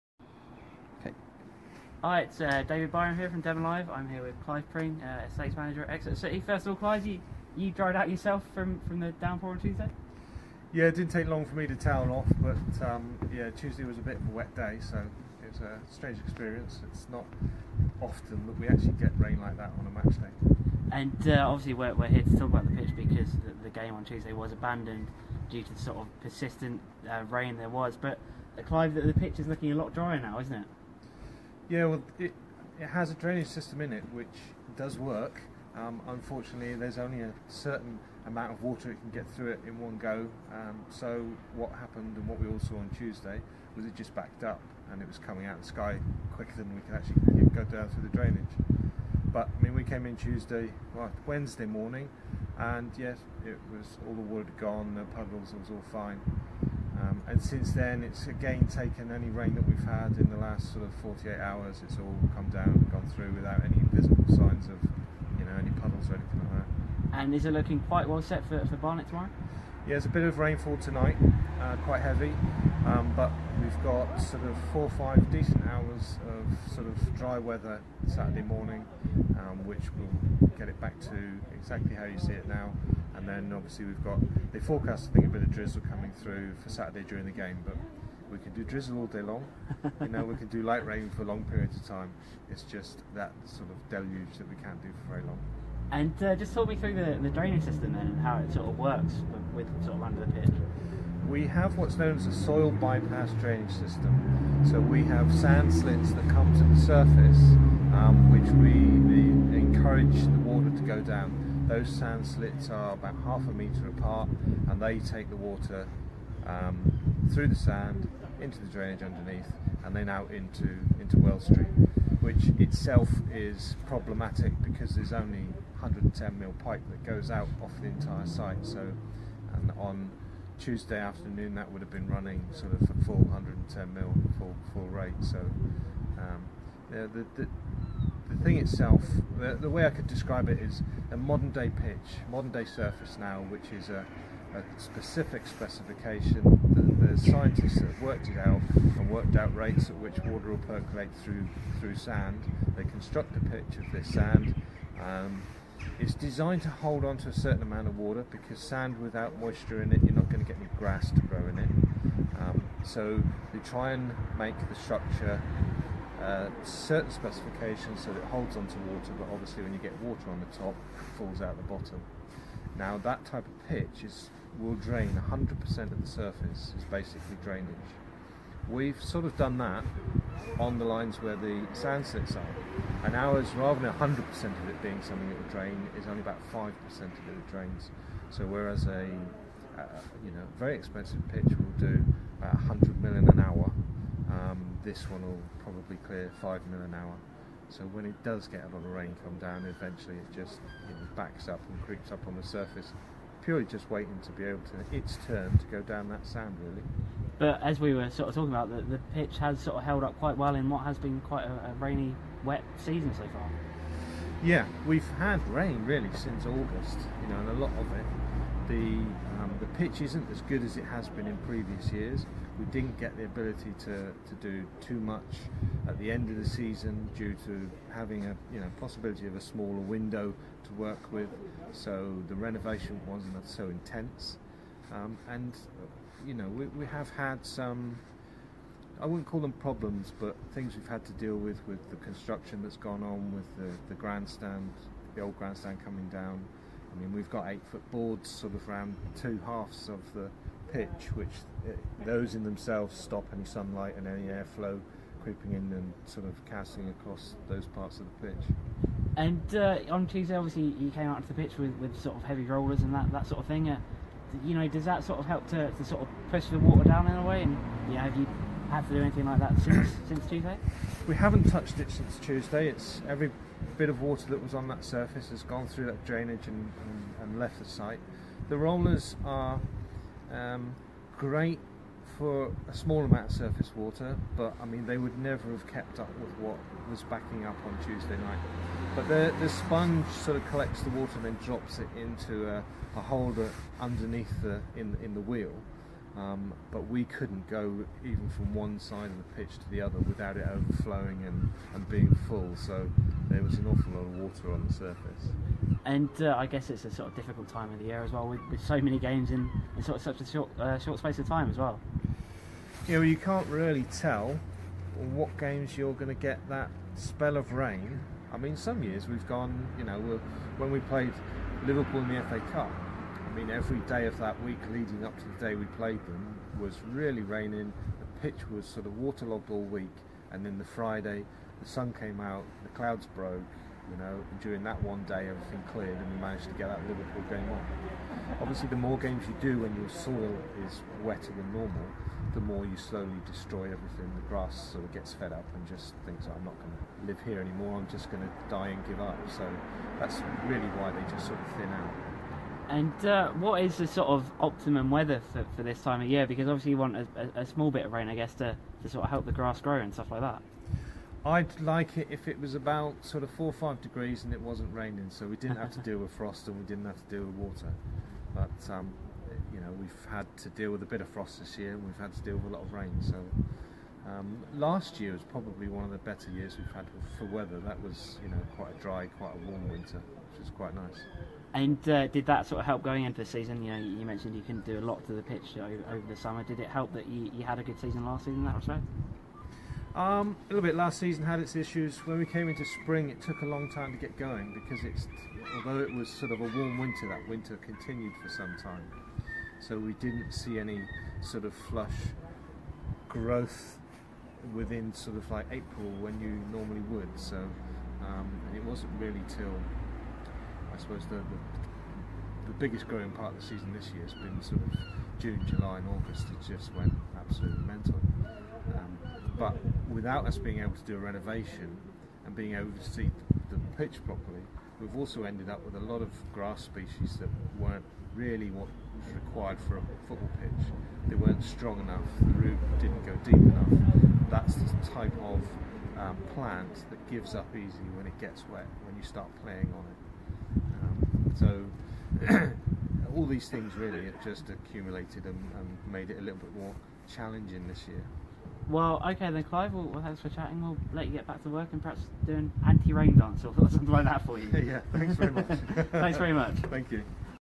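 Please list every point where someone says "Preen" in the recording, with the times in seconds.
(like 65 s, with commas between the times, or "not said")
4 s.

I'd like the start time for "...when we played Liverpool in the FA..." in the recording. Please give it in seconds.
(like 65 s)
320 s.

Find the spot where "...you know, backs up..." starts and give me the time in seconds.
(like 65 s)
200 s.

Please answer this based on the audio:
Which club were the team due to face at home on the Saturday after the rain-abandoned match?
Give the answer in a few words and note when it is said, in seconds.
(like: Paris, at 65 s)
Barnet, at 68 s.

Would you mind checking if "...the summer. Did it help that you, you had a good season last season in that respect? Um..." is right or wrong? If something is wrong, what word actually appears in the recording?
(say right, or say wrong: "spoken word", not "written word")
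right.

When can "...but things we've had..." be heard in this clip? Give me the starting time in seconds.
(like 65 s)
240 s.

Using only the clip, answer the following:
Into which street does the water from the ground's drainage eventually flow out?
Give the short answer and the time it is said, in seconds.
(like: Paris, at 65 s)
Well Street, at 121 s.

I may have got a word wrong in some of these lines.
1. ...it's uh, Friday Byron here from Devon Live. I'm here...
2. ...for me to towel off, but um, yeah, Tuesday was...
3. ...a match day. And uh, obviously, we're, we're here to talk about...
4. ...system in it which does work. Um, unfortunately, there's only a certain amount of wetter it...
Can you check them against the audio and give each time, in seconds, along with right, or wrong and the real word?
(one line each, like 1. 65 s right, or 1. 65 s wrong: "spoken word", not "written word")
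1. 2 s wrong: "David", not "Friday"
2. 11 s right
3. 19 s right
4. 33 s wrong: "water", not "wetter".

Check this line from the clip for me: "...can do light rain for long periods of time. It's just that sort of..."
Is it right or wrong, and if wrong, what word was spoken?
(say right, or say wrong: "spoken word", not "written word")
right.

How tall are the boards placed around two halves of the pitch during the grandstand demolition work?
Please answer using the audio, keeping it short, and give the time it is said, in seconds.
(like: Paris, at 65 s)
8 foot, at 247 s.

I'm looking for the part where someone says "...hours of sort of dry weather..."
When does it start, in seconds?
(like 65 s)
75 s.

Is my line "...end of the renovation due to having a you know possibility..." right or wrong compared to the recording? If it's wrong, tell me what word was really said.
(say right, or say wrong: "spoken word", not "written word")
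wrong: "season", not "renovation".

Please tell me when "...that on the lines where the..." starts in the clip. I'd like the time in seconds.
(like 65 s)
179 s.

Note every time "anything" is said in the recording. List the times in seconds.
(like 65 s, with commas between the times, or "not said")
66 s, 269 s.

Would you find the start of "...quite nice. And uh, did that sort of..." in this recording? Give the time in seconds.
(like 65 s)
380 s.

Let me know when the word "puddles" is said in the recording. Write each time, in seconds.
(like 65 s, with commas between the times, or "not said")
55 s, 65 s.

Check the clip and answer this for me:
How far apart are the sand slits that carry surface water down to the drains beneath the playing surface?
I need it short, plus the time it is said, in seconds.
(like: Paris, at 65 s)
half a metre, at 113 s.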